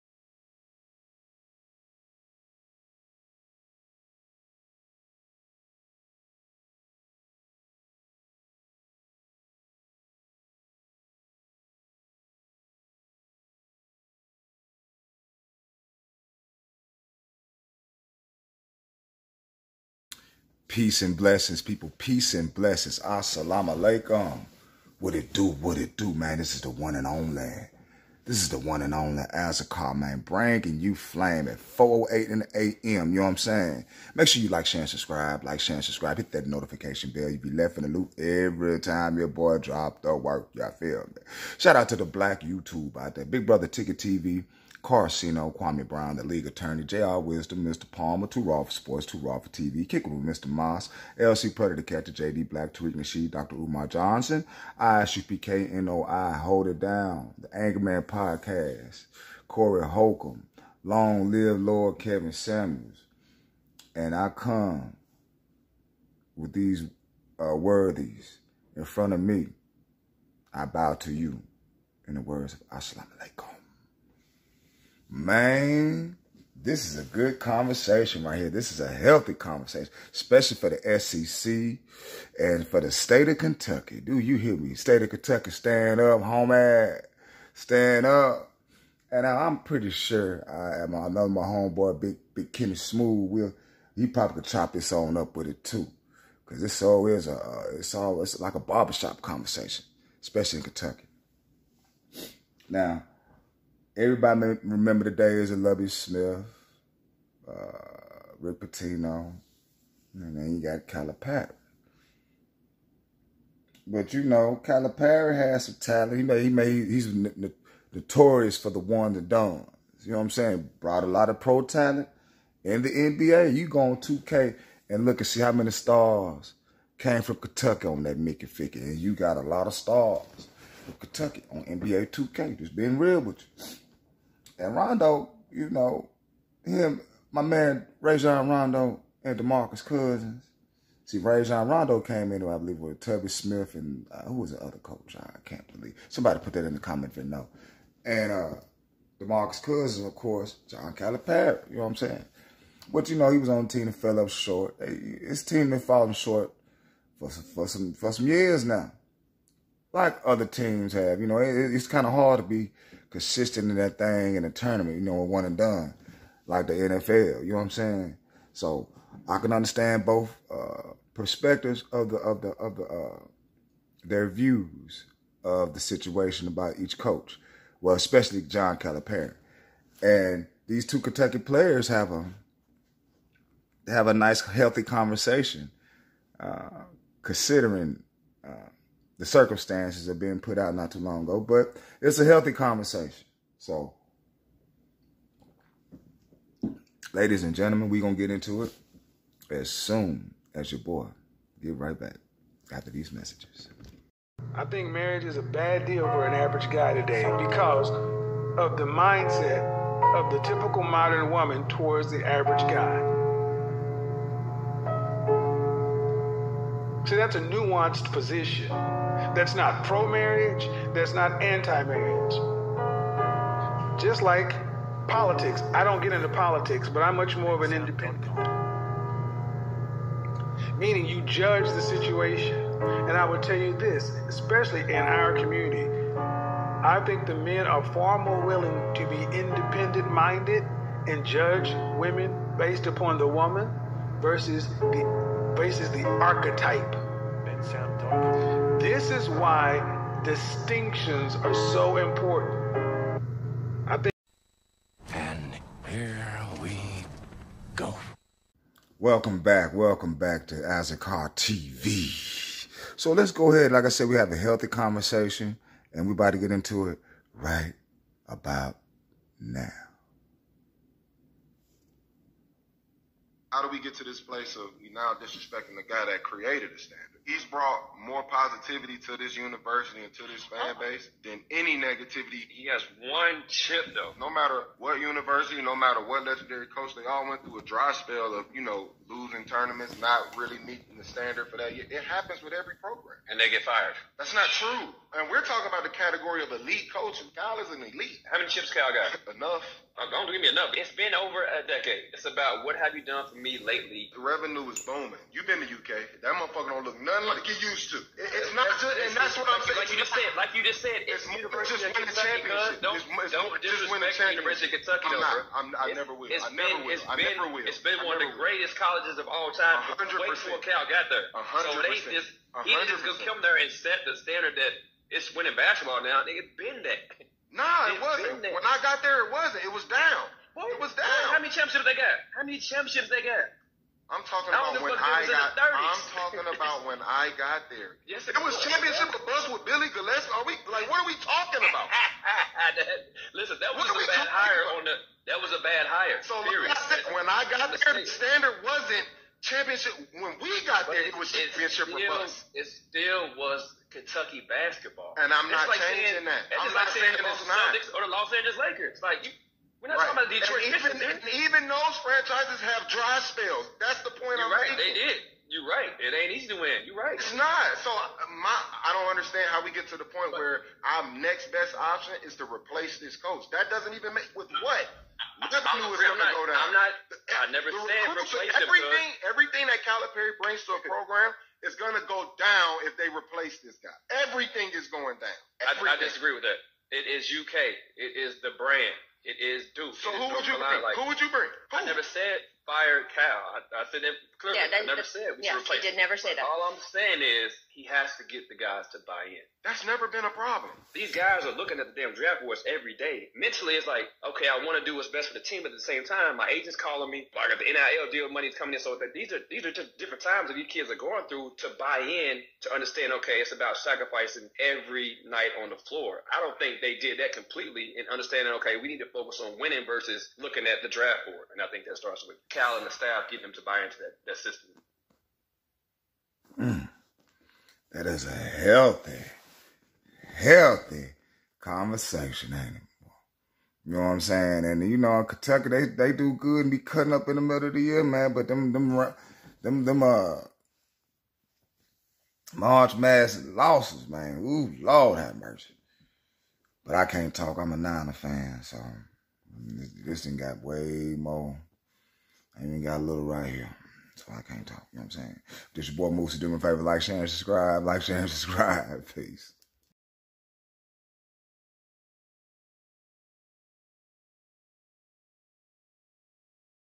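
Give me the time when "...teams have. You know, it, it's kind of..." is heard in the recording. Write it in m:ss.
2:40.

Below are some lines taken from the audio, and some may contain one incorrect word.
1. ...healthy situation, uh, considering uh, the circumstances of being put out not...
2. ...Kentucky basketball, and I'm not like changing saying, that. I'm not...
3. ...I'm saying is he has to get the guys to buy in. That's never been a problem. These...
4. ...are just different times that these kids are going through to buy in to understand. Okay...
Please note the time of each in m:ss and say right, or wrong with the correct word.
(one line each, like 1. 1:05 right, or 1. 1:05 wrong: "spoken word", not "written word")
1. 3:04 wrong: "conversation", not "situation"
2. 5:53 right
3. 6:36 right
4. 6:49 right.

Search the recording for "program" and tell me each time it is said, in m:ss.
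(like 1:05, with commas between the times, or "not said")
4:52, 6:20.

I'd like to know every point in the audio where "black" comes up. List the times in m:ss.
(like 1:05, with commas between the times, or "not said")
0:42, 0:52.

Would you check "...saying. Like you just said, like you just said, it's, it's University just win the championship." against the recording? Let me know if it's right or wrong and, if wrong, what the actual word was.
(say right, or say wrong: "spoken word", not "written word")
right.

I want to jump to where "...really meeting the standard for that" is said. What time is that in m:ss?
4:50.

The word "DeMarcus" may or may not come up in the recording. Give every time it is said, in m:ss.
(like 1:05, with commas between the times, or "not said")
2:19, 2:29.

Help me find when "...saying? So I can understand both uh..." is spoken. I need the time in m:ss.
2:47.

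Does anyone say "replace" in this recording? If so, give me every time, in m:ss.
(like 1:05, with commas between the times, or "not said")
6:12, 6:18, 6:23.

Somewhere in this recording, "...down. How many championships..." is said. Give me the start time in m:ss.
5:30.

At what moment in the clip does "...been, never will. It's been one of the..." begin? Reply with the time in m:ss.
5:17.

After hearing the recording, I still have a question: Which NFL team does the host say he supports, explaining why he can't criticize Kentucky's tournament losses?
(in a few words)
49ers.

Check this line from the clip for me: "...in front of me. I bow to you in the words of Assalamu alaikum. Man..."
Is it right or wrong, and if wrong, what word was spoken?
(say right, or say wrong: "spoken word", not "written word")
right.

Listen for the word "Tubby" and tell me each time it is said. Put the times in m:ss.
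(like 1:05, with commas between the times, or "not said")
1:45, 2:23.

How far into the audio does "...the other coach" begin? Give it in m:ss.
2:24.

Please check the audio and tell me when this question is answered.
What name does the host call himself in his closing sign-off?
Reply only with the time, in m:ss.
7:36.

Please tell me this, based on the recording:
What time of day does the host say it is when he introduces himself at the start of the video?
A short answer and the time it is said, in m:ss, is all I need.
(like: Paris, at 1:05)
4:08 AM, at 0:31.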